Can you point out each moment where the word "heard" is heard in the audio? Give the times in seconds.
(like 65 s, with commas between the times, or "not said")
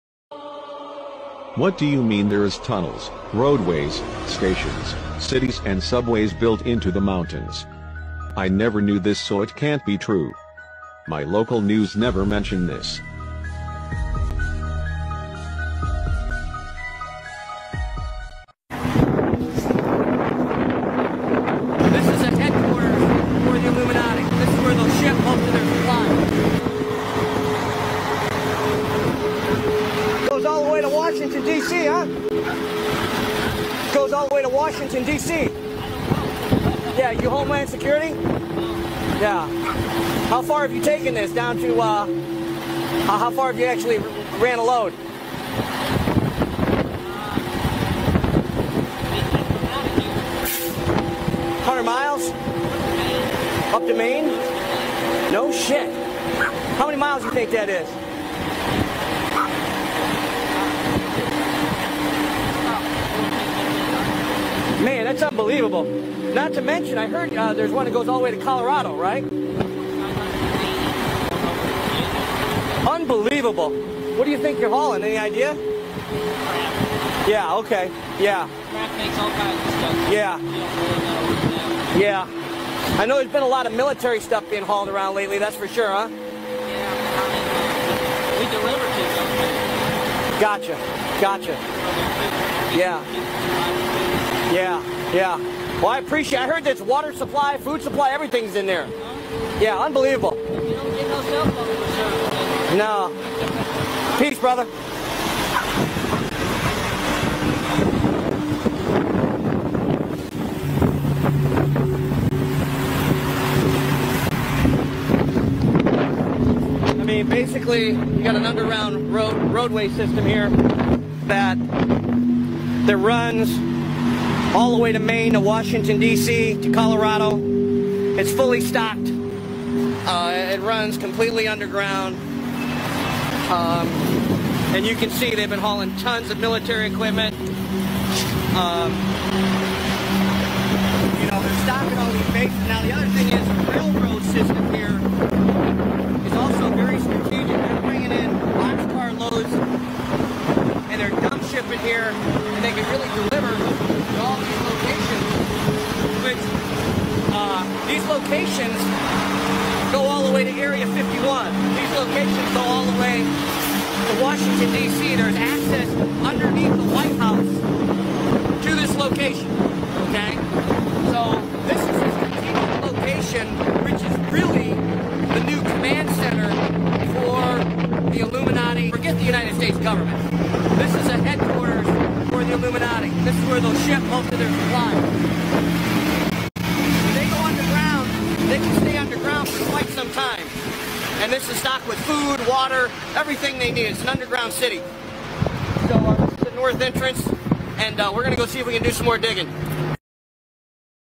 67 s, 96 s.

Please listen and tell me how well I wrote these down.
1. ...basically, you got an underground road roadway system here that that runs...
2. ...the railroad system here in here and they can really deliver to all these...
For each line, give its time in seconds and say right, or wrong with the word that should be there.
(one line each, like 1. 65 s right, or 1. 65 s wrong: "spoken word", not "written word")
1. 117 s right
2. 143 s right.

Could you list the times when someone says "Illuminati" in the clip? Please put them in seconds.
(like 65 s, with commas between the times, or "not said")
23 s, 178 s, 182 s.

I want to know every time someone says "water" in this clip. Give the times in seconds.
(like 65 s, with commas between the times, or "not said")
96 s, 192 s.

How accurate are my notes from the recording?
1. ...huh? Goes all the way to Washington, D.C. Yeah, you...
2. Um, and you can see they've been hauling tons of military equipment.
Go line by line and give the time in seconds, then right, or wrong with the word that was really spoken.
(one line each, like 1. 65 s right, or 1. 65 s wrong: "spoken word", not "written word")
1. 31 s right
2. 133 s right.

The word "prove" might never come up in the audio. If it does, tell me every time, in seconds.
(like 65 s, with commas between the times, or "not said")
not said.